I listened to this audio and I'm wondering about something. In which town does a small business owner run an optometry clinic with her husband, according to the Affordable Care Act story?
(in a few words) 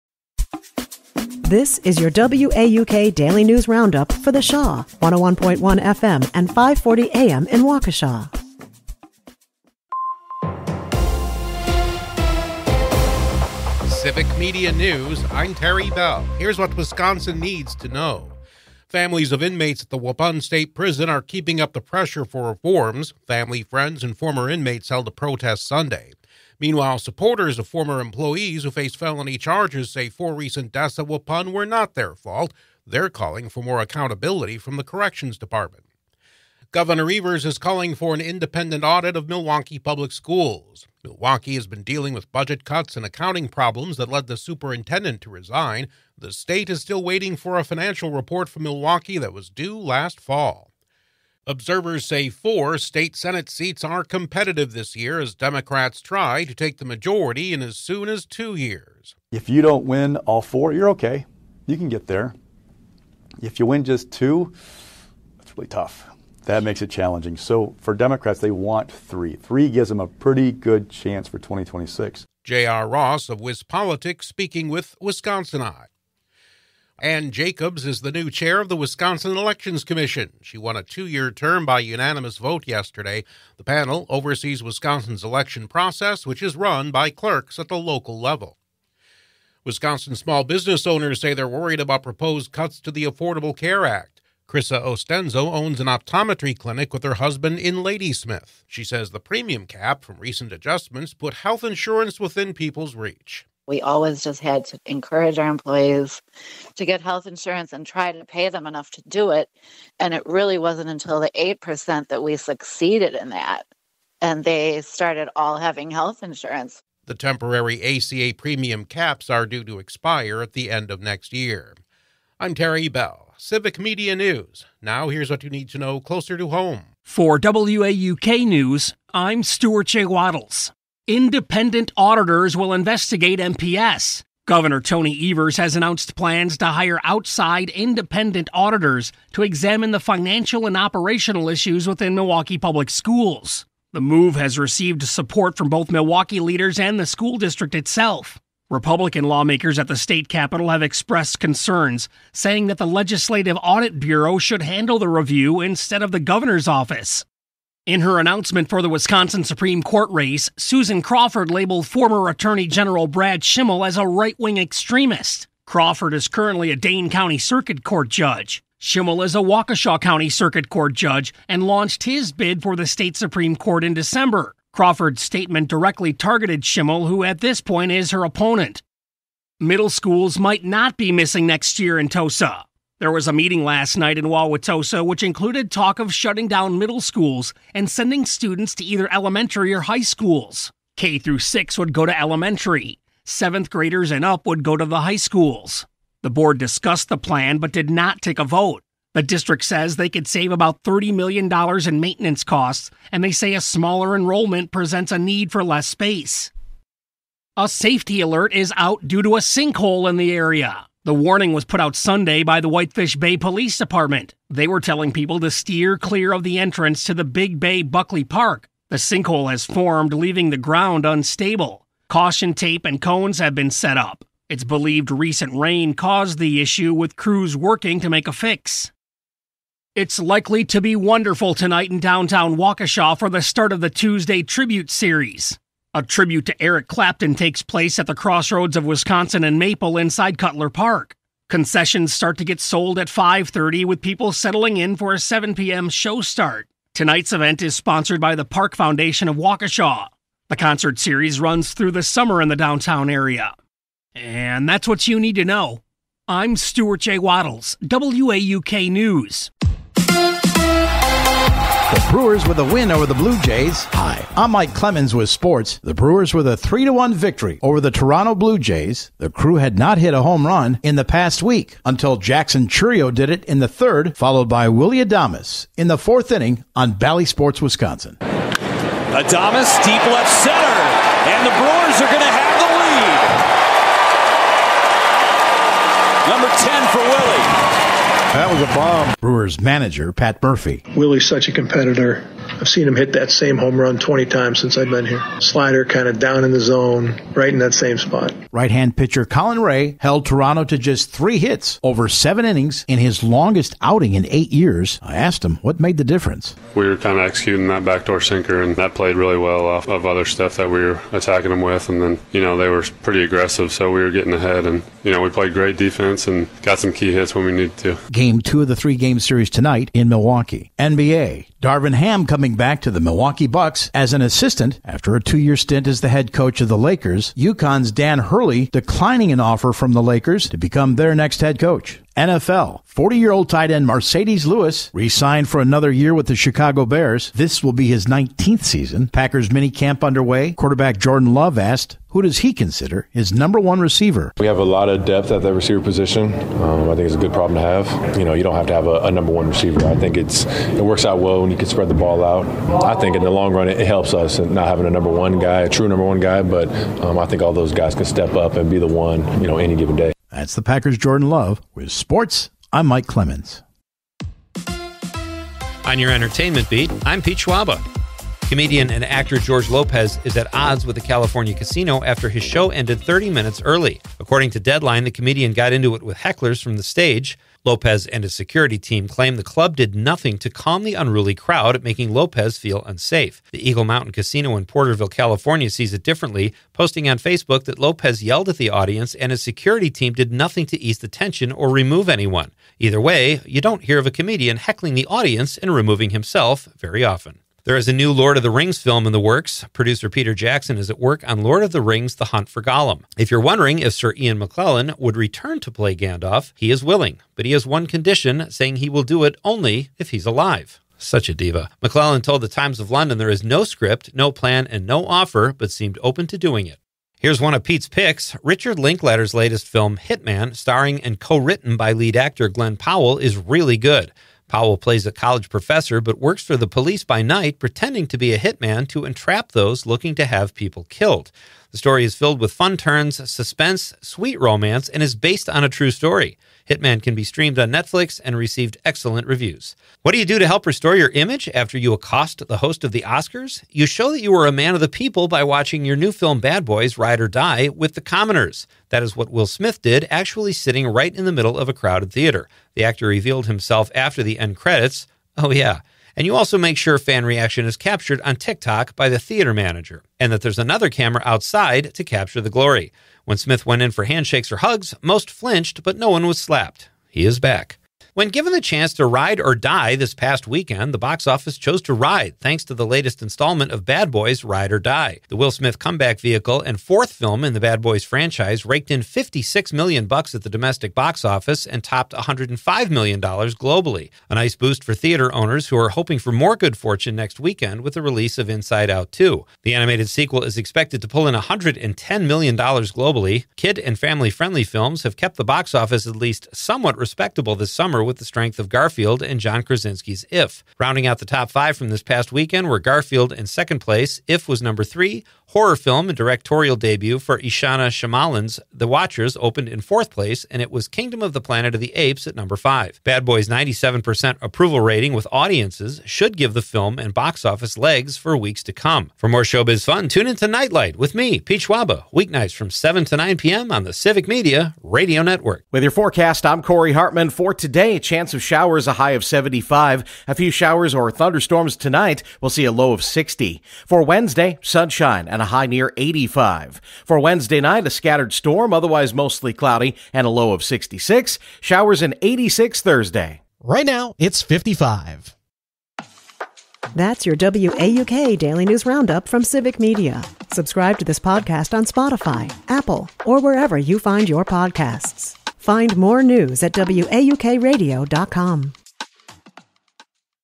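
Ladysmith.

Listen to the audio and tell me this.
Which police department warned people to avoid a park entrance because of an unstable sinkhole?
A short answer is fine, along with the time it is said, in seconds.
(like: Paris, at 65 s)
Whitefish Bay, at 212 s.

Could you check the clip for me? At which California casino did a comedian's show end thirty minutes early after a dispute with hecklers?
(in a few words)
Eagle Mountain Casino.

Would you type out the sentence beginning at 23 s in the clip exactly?
Family, friends, and former inmates held a protest Sunday.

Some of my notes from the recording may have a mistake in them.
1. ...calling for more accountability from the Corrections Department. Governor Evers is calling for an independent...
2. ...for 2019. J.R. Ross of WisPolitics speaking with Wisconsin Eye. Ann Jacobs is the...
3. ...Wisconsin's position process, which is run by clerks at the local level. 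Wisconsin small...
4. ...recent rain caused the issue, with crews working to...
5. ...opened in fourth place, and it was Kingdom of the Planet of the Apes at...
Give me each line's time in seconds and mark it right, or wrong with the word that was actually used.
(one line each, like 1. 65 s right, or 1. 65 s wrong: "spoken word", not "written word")
1. 33 s right
2. 71 s wrong: "2026", not "2019"
3. 84 s wrong: "election", not "position"
4. 225 s right
5. 509 s right.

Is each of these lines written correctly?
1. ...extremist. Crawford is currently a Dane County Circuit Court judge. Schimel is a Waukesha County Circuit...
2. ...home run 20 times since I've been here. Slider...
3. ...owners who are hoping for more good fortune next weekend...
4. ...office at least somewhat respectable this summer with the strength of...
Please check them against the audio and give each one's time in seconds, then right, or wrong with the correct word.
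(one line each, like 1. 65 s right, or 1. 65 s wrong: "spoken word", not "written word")
1. 164 s right
2. 293 s right
3. 485 s right
4. 495 s right.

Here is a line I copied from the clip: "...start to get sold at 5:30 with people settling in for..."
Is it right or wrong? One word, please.
right.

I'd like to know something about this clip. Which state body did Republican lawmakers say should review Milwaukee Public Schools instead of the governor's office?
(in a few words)
Legislative Audit Bureau.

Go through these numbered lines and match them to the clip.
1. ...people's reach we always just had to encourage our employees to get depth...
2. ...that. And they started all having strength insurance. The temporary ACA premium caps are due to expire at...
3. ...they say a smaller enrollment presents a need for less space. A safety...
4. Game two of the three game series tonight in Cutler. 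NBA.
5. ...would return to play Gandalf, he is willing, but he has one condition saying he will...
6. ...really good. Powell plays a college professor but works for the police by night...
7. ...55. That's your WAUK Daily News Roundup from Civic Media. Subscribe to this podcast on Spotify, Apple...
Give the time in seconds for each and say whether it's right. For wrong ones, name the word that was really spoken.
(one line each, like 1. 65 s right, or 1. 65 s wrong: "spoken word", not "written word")
1. 102 s wrong: "health", not "depth"
2. 113 s wrong: "health", not "strength"
3. 203 s right
4. 318 s wrong: "Milwaukee", not "Cutler"
5. 404 s right
6. 423 s right
7. 544 s right.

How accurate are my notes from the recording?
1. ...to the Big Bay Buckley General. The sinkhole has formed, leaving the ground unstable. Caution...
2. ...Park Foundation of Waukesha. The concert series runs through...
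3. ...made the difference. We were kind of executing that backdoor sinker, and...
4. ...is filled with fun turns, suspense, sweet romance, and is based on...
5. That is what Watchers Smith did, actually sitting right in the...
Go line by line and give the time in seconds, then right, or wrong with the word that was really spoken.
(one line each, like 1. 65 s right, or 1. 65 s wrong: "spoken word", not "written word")
1. 217 s wrong: "Park", not "General"
2. 248 s right
3. 305 s right
4. 432 s right
5. 448 s wrong: "Will", not "Watchers".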